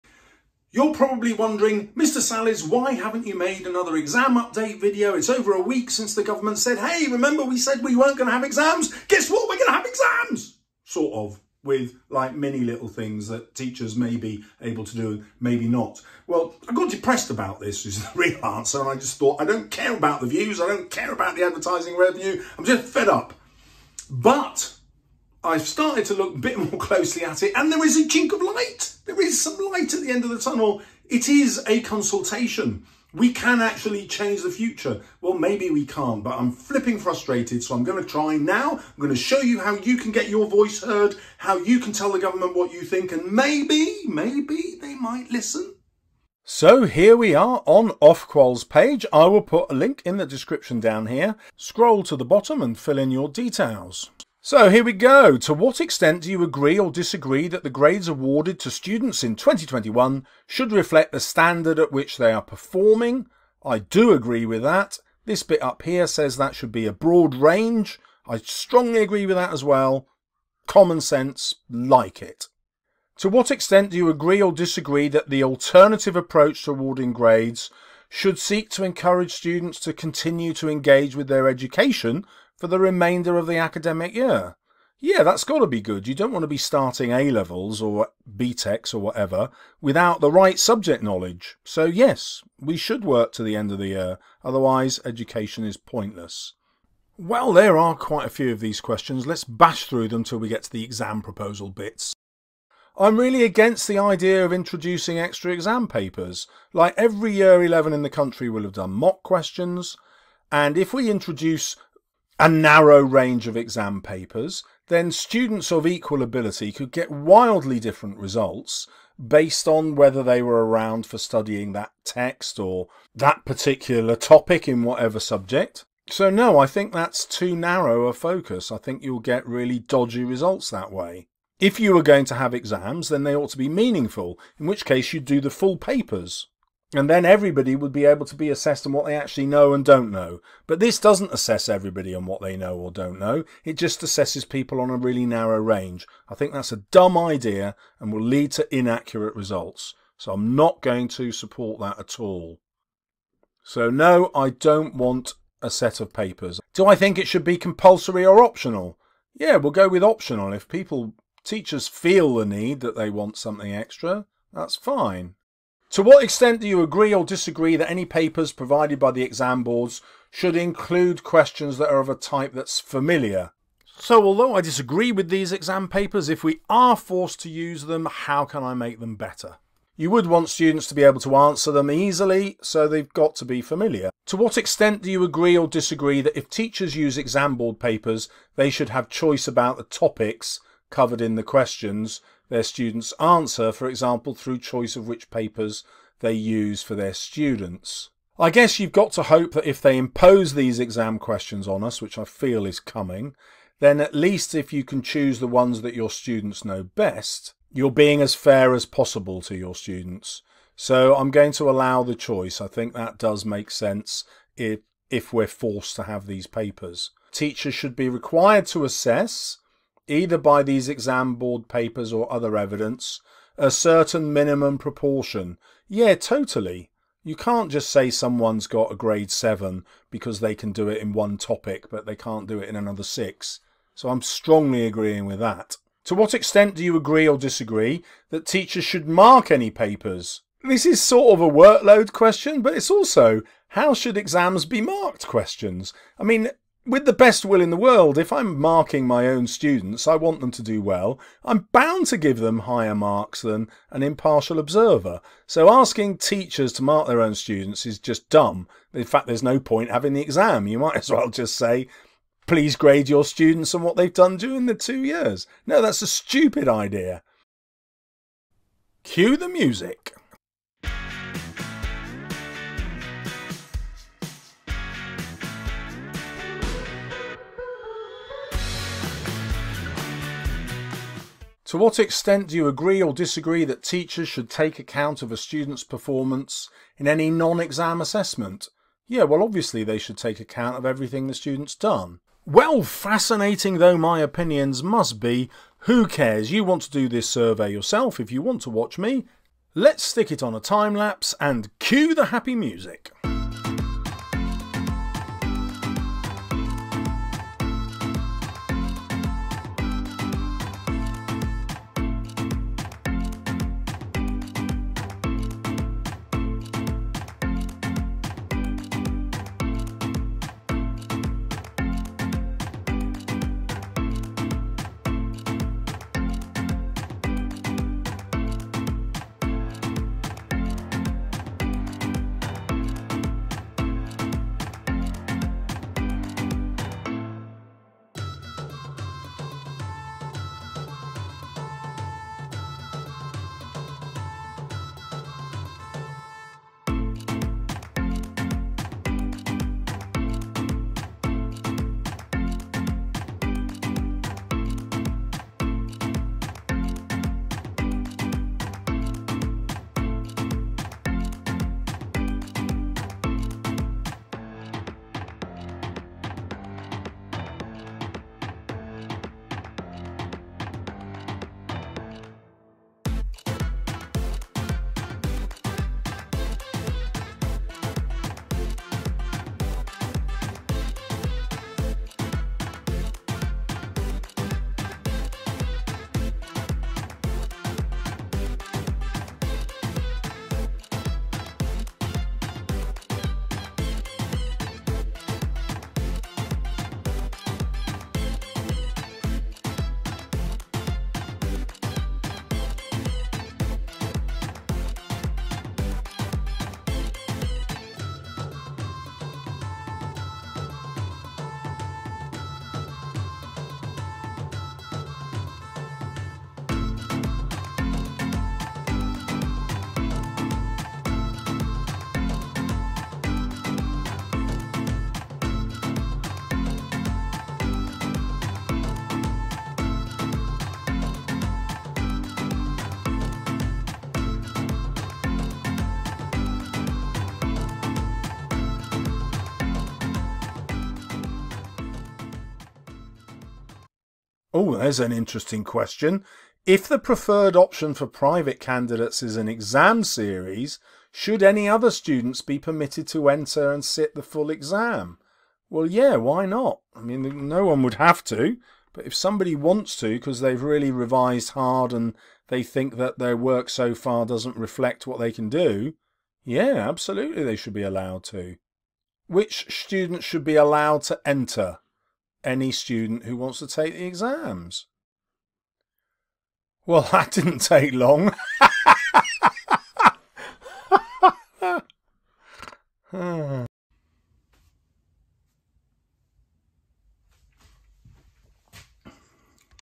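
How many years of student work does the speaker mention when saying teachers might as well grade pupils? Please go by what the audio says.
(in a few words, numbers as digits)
2.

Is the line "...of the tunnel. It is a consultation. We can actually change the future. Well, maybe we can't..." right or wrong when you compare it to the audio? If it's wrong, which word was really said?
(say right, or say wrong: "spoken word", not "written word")
right.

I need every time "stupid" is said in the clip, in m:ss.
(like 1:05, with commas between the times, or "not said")
4:26.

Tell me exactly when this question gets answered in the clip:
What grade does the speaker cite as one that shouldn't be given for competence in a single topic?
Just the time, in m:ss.
3:48.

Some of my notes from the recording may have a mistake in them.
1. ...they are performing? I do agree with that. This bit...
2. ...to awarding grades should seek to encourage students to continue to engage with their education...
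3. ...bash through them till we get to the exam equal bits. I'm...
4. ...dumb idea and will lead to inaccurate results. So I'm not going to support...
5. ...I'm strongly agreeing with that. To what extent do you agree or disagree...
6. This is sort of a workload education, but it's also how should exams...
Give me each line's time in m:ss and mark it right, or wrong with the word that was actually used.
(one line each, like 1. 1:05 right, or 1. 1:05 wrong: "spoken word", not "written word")
1. 1:02 right
2. 1:16 right
3. 1:39 wrong: "proposal", not "equal"
4. 2:26 right
5. 3:54 right
6. 4:00 wrong: "question", not "education".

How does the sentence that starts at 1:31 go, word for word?
So, yes, we should work to the end of the year, otherwise, education is pointless.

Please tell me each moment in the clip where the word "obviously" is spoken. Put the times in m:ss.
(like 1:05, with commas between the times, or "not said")
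4:49.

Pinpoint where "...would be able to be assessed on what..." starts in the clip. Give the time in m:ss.
2:17.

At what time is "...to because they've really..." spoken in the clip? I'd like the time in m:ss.
7:40.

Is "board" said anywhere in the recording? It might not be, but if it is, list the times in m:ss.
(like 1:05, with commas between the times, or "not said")
2:49, 3:07, 3:41.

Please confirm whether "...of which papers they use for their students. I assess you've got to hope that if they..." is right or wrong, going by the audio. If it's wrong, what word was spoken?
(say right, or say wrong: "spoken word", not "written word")
wrong: "guess", not "assess".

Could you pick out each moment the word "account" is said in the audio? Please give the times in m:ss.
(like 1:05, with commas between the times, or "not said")
4:44, 4:50.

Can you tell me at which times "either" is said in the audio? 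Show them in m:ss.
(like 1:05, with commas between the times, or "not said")
3:40.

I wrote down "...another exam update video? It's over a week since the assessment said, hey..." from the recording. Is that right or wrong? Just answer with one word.
wrong.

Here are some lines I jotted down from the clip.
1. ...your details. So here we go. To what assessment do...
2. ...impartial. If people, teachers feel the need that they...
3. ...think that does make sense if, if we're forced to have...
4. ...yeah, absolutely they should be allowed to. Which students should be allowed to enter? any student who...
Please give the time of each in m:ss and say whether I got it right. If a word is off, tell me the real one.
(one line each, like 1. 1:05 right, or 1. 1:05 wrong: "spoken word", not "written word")
1. 0:53 wrong: "extent", not "assessment"
2. 2:40 wrong: "optional", not "impartial"
3. 3:32 right
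4. 7:46 right.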